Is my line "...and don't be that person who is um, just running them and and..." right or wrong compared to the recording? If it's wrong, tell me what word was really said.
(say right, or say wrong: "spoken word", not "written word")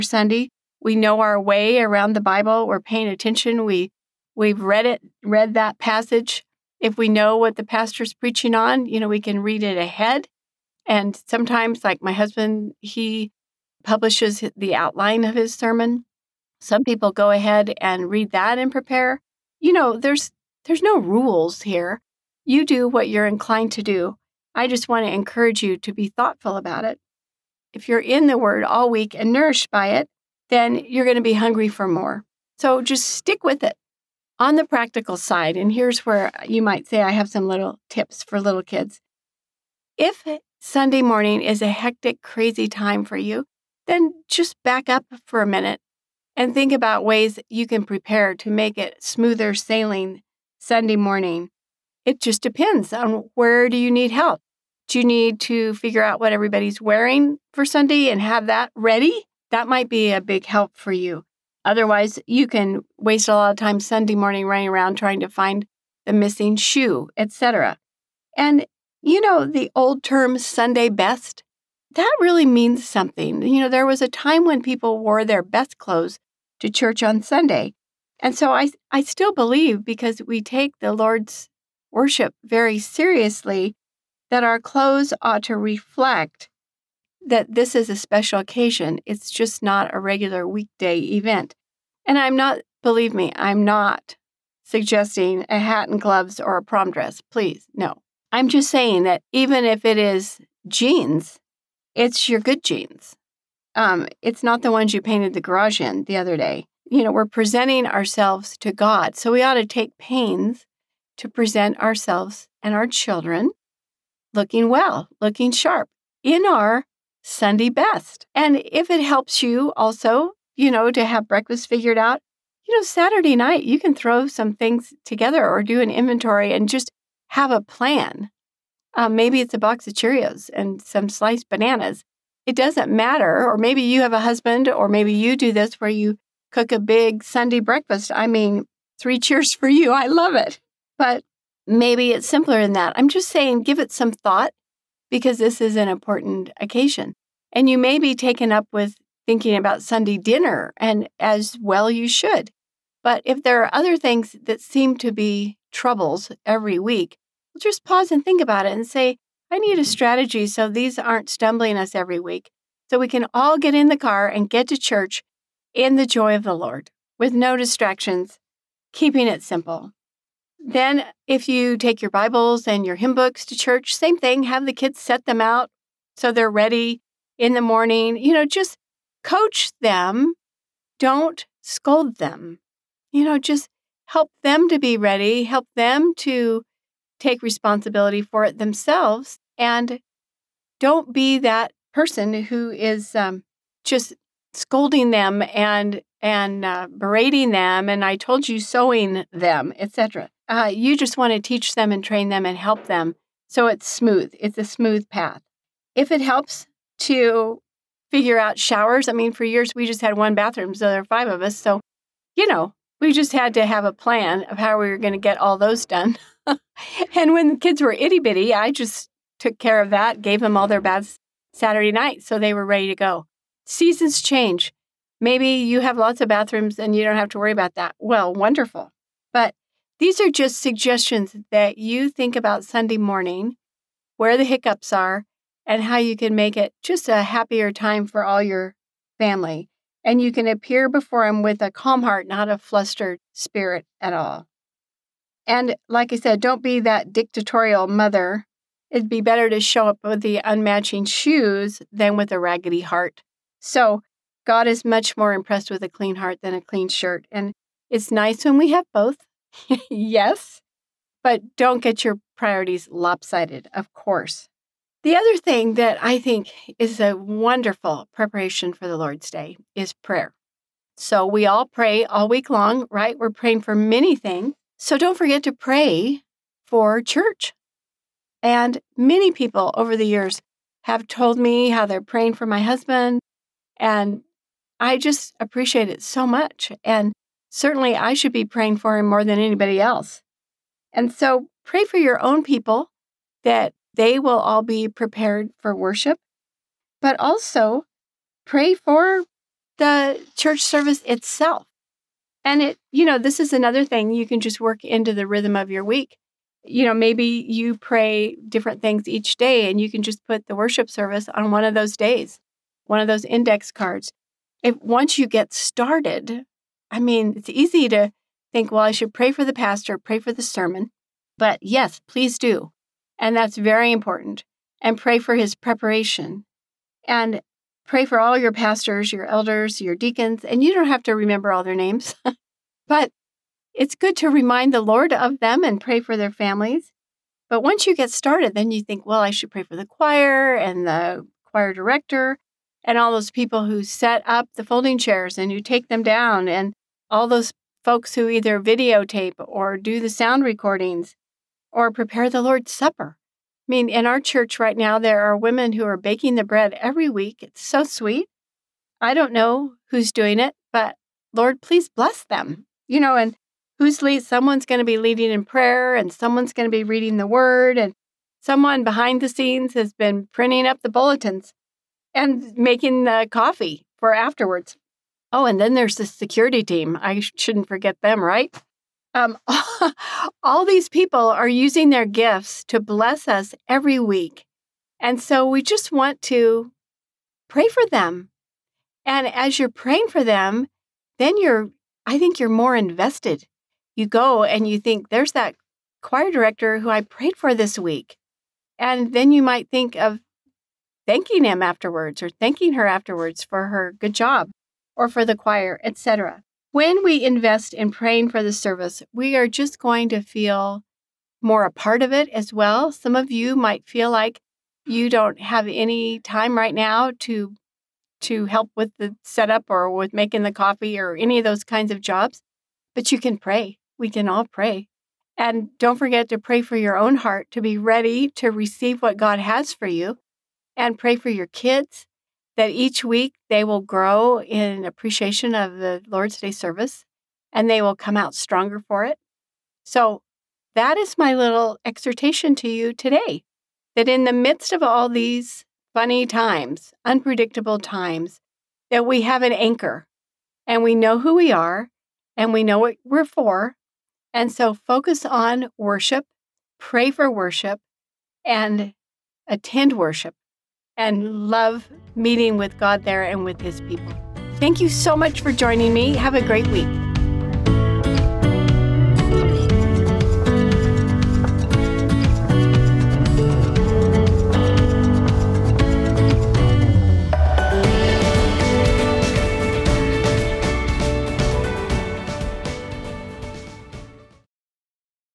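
wrong: "scolding", not "running".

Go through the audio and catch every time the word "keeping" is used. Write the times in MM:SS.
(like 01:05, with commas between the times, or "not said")
02:48.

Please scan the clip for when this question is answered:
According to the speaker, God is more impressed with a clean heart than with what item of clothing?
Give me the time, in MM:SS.
04:16.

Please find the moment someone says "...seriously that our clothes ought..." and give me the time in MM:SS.
01:22.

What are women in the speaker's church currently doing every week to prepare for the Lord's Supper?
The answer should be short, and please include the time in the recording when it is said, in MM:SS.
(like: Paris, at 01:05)
baking the bread, at 05:55.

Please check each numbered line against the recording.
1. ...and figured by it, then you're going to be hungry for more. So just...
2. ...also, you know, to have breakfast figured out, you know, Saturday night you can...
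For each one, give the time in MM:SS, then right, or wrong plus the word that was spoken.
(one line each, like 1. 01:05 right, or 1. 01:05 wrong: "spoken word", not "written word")
1. 00:29 wrong: "nourished", not "figured"
2. 01:59 right.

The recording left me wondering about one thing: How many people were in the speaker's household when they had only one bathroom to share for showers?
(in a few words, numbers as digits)
5.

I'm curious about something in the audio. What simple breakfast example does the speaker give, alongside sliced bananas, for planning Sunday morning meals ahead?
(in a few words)
a box of Cheerios.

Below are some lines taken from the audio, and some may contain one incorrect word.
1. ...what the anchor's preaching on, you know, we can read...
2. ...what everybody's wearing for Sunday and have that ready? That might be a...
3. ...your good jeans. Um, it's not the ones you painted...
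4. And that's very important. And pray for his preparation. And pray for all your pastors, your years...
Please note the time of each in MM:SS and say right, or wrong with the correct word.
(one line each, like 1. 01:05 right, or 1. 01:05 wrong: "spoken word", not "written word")
1. 00:07 wrong: "pastor", not "anchor"
2. 00:56 right
3. 01:42 right
4. 05:23 wrong: "elders", not "years".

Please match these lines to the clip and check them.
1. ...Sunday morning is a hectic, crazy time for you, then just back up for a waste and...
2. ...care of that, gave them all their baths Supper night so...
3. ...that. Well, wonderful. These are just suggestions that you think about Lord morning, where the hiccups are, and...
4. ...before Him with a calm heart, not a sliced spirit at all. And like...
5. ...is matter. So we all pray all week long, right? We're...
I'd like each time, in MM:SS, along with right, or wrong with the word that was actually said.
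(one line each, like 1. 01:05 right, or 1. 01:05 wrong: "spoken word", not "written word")
1. 00:40 wrong: "minute", not "waste"
2. 03:39 wrong: "Saturday", not "Supper"
3. 03:47 wrong: "Sunday", not "Lord"
4. 04:00 wrong: "flustered", not "sliced"
5. 04:29 wrong: "prayer", not "matter".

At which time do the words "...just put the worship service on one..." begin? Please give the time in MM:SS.
05:10.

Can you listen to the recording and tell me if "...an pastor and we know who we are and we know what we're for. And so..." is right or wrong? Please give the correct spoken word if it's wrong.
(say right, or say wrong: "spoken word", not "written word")
wrong: "anchor", not "pastor".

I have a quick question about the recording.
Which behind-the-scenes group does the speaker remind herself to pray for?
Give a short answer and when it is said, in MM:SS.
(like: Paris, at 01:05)
the security team, at 06:16.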